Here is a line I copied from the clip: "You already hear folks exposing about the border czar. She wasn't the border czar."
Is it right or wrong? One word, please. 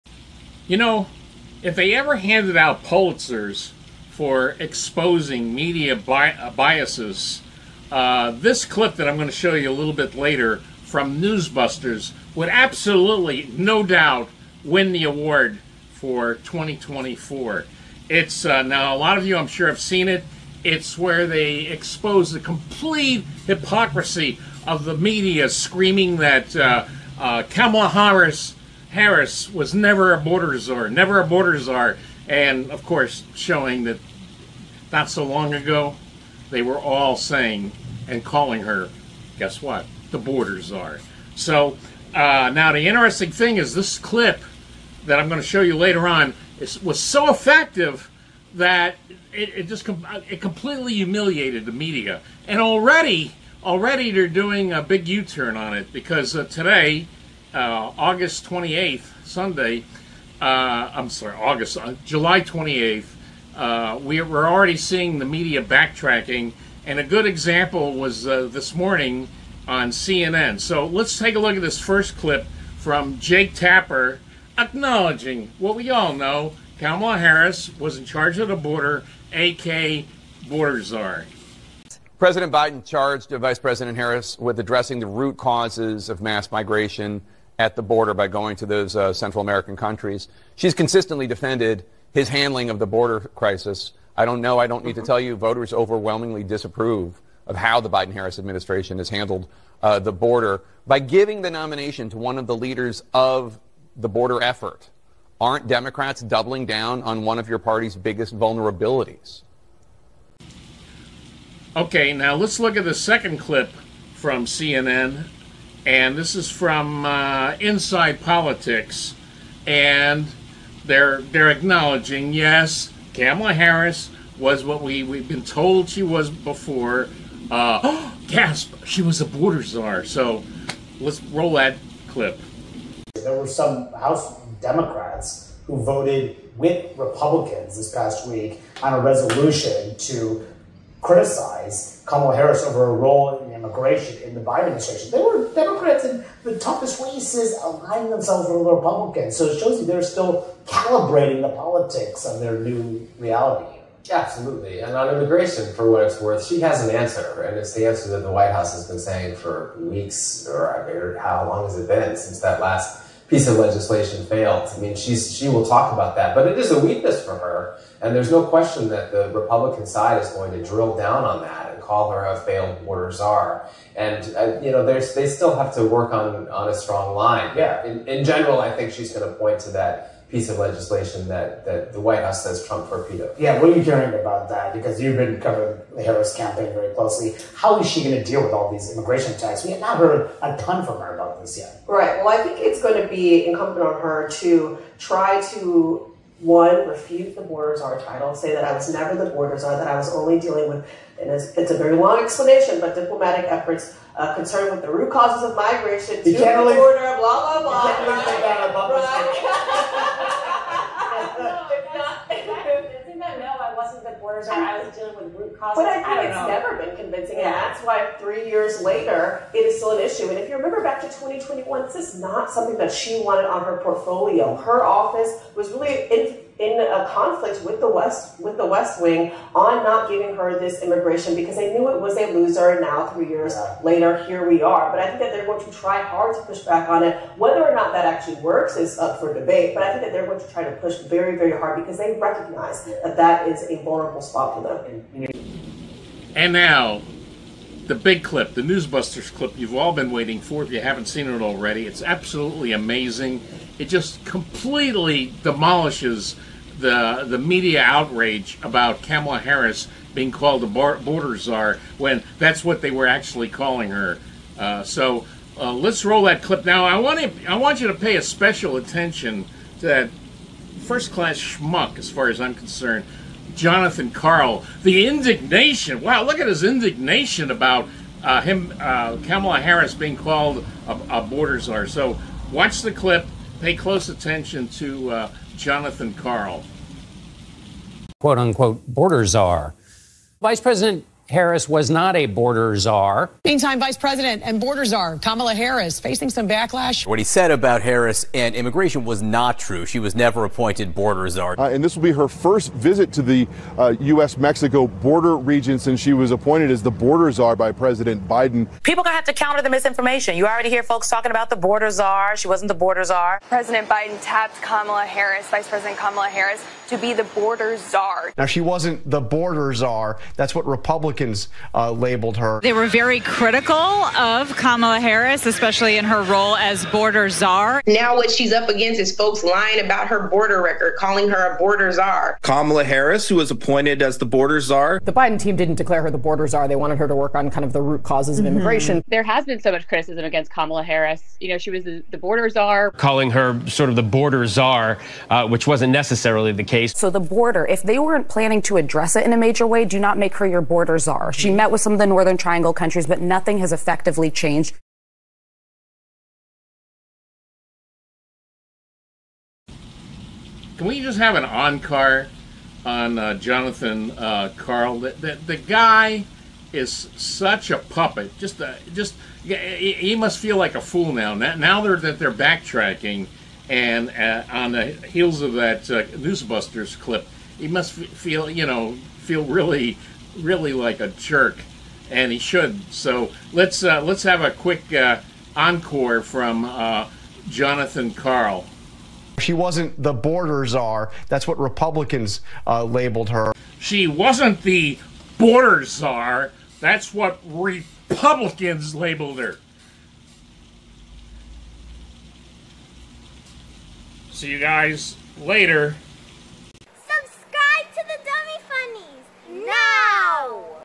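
wrong.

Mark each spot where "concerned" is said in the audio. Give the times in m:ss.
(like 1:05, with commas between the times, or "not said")
3:24, 4:32.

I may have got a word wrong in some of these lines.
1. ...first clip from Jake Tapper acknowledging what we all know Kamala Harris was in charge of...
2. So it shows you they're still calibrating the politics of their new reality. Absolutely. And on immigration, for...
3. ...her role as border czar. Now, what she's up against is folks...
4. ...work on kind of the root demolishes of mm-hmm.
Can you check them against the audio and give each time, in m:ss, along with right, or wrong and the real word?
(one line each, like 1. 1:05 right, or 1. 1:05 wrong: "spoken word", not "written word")
1. 1:11 right
2. 2:29 right
3. 5:26 right
4. 5:37 wrong: "causes", not "demolishes".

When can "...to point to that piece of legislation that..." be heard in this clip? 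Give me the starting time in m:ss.
2:59.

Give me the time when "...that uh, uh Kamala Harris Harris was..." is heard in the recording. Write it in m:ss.
0:26.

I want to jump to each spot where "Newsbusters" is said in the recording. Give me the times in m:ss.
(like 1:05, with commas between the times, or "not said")
0:11, 4:08, 6:16.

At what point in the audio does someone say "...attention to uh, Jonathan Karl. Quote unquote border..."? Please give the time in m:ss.
4:44.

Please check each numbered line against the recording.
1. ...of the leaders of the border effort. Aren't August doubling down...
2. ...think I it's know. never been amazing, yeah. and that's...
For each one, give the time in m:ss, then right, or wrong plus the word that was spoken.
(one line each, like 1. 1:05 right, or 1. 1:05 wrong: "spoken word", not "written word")
1. 1:42 wrong: "Democrats", not "August"
2. 3:35 wrong: "convincing", not "amazing".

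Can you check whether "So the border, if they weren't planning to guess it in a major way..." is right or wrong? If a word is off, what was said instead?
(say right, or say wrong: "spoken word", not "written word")
wrong: "address", not "guess".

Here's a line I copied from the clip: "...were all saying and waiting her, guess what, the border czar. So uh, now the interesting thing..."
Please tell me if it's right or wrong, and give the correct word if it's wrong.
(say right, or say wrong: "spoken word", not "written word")
wrong: "calling", not "waiting".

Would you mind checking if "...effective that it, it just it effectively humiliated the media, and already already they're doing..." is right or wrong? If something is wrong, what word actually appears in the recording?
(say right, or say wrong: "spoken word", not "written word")
wrong: "completely", not "effectively".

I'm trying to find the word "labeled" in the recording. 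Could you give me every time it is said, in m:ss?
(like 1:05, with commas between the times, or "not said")
5:21, 6:32, 6:38.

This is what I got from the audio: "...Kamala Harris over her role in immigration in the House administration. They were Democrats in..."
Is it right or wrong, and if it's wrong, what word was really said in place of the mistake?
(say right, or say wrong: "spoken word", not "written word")
wrong: "Biden", not "House".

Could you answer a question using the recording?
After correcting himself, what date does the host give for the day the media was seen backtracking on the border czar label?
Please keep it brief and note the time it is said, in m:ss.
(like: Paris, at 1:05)
July 28th, at 1:02.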